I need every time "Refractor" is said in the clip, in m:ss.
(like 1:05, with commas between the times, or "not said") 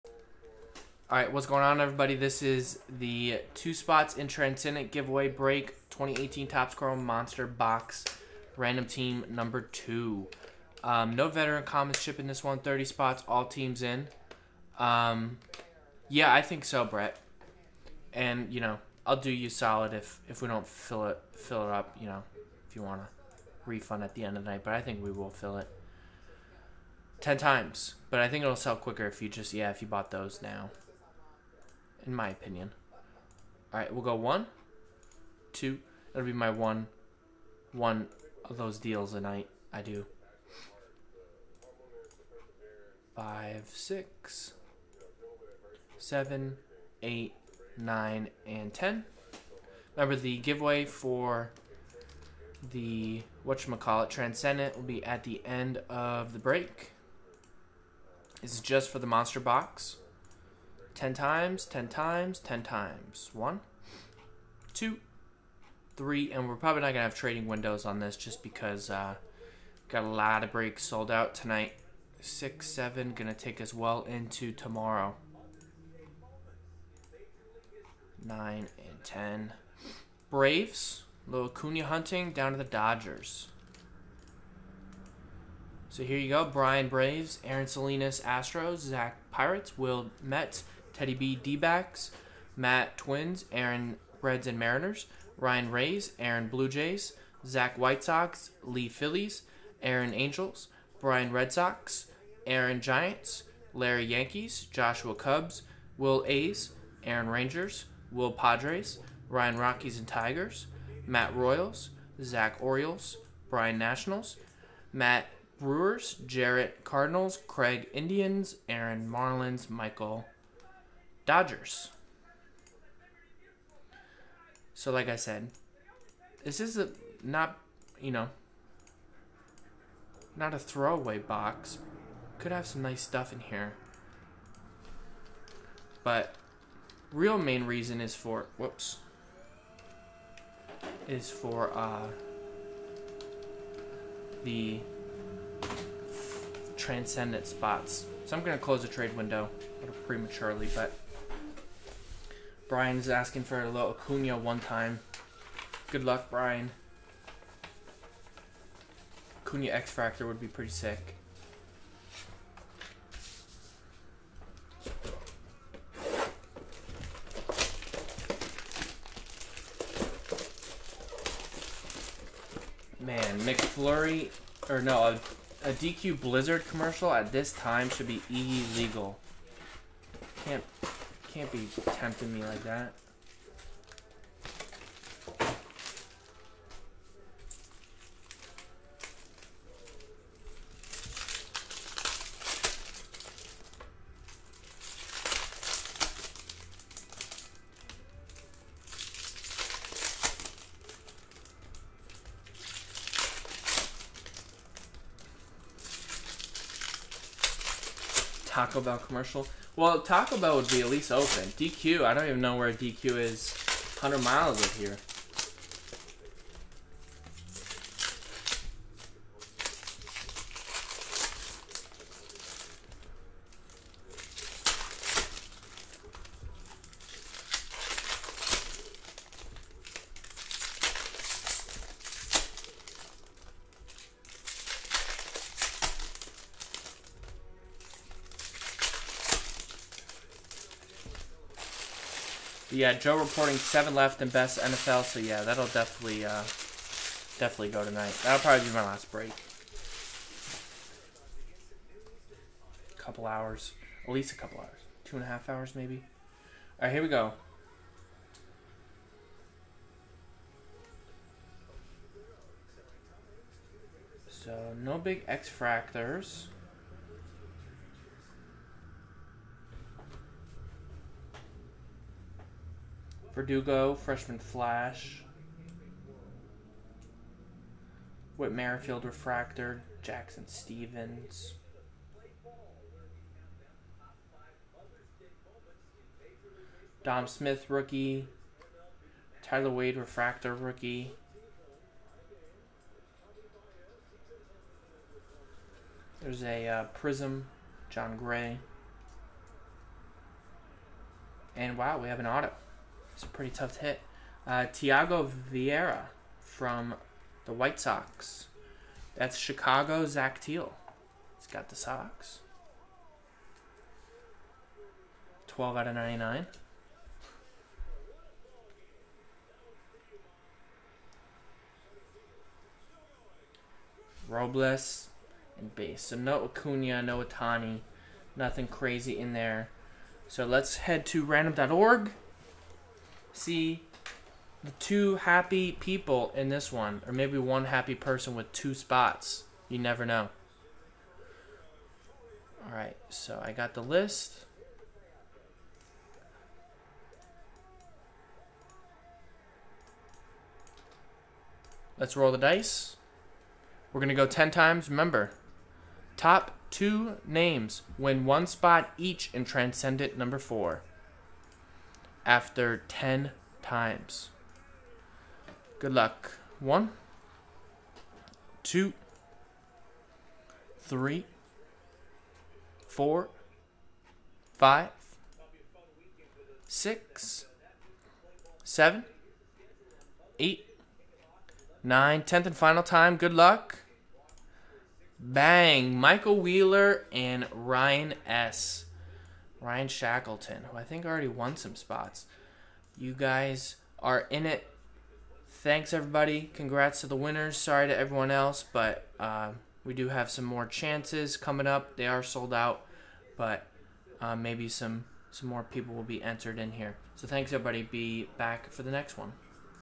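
4:39, 4:49.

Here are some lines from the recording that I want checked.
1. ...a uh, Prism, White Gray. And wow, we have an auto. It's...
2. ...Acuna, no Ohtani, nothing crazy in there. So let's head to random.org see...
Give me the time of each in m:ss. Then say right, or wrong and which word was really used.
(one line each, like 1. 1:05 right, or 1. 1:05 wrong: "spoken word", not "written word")
1. 4:56 wrong: "Jon", not "White"
2. 5:26 right.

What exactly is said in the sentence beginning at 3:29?
Well, Taco Bell would be at least open.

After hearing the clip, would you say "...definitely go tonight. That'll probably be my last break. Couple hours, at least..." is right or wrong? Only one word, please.
right.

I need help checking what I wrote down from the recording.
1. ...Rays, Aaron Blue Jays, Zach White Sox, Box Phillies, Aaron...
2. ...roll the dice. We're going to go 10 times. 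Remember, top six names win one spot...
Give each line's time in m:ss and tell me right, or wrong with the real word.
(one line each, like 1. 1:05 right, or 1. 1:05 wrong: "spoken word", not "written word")
1. 1:35 wrong: "Lee", not "Box"
2. 5:52 wrong: "two", not "six".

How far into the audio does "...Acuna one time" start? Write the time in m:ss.
2:33.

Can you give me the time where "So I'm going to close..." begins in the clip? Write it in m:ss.
2:28.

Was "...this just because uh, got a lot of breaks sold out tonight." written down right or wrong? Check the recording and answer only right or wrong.
right.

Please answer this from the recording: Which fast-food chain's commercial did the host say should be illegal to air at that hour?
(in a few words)
DQ Blizzard.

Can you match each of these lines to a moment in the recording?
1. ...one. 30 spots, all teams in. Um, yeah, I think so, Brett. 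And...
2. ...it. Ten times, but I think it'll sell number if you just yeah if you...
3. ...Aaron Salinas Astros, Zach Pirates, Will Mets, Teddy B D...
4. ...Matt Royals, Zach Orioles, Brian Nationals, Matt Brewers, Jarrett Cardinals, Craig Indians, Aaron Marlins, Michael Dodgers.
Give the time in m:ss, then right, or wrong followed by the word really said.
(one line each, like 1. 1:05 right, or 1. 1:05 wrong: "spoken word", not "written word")
1. 0:12 right
2. 0:25 wrong: "quicker", not "number"
3. 1:27 right
4. 1:51 right.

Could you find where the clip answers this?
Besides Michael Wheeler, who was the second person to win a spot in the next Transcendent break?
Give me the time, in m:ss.
6:29.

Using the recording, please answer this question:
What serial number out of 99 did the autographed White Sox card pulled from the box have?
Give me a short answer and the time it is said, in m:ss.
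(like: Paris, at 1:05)
12, at 5:15.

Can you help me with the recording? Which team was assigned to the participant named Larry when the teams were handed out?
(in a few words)
Yankees.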